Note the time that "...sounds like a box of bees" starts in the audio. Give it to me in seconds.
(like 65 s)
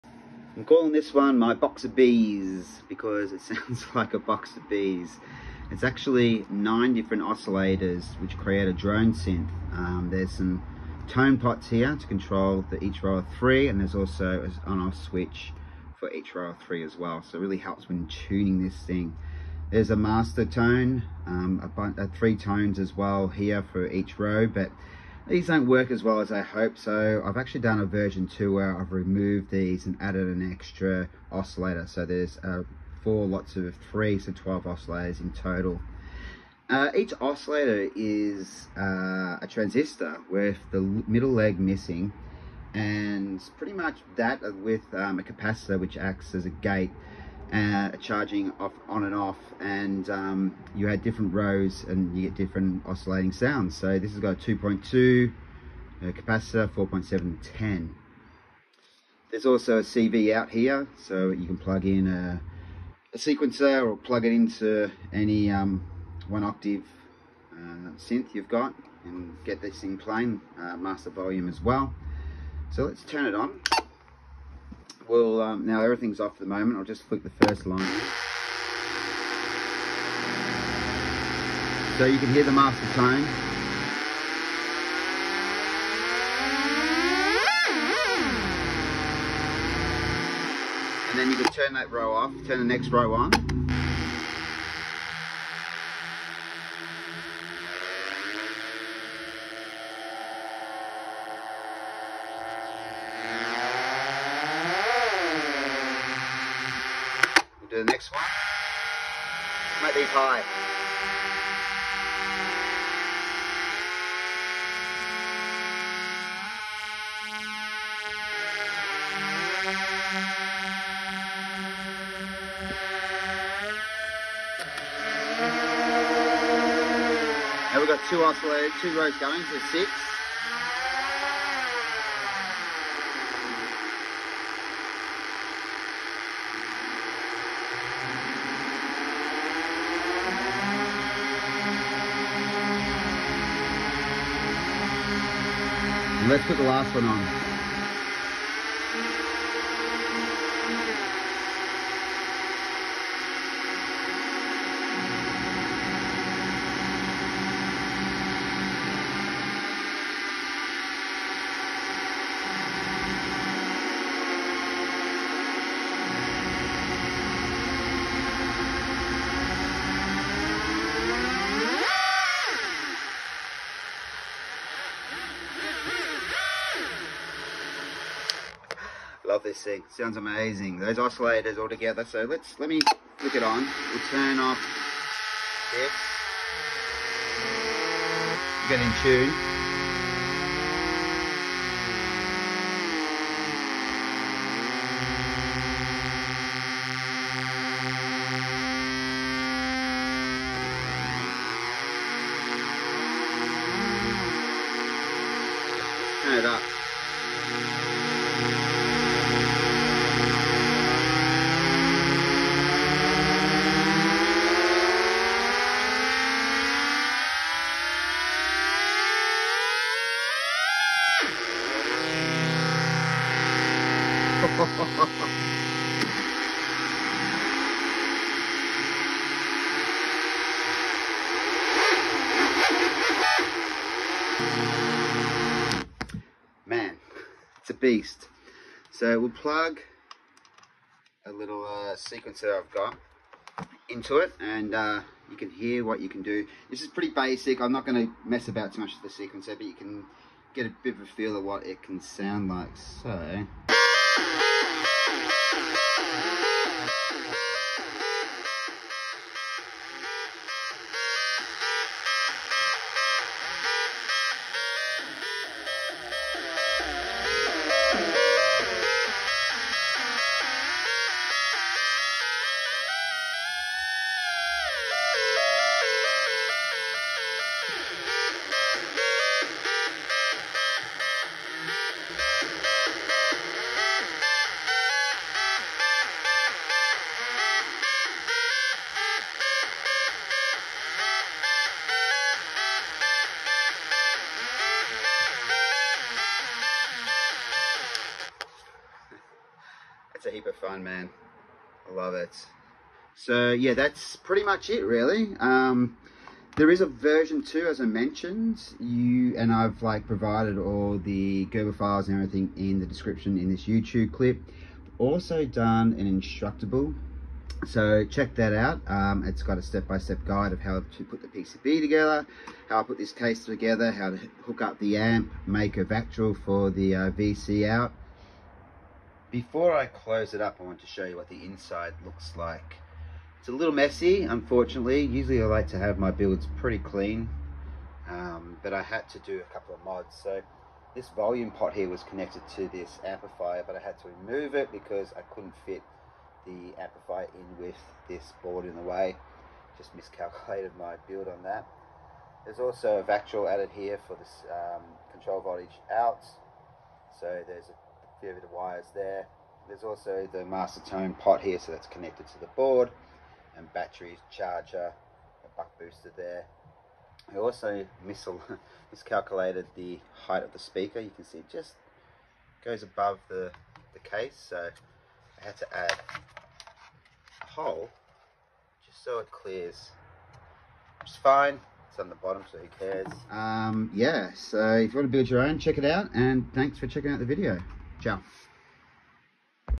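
3 s.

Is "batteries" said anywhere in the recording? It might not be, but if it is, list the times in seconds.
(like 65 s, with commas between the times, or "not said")
363 s.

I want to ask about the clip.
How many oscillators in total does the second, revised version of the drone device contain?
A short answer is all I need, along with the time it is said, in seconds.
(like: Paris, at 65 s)
12, at 34 s.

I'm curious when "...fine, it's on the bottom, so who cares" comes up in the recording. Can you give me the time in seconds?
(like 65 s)
381 s.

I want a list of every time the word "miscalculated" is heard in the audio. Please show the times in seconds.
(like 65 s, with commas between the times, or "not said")
349 s, 368 s.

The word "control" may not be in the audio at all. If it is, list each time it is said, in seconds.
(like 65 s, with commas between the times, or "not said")
12 s, 355 s.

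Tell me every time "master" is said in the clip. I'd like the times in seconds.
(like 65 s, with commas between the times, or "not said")
19 s, 70 s, 82 s, 360 s.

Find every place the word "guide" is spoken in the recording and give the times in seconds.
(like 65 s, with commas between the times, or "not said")
320 s.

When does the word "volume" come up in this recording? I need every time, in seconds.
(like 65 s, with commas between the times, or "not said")
71 s, 341 s.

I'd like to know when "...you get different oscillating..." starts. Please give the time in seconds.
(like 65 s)
52 s.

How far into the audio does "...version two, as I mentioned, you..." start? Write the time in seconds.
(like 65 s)
306 s.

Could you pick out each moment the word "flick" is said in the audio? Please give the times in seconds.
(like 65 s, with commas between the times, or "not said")
77 s, 183 s.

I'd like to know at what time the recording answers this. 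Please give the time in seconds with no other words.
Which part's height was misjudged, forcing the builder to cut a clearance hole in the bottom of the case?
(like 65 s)
370 s.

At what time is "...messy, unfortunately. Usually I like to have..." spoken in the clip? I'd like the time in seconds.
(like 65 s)
333 s.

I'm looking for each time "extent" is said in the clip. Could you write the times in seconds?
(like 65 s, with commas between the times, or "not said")
not said.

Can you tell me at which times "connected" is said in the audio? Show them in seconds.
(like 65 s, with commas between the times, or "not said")
342 s, 361 s.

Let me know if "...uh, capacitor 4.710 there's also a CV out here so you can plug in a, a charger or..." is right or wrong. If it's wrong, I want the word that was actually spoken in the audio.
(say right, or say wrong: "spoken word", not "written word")
wrong: "sequencer", not "charger".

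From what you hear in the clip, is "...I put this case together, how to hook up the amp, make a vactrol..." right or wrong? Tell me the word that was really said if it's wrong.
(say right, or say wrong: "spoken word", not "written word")
right.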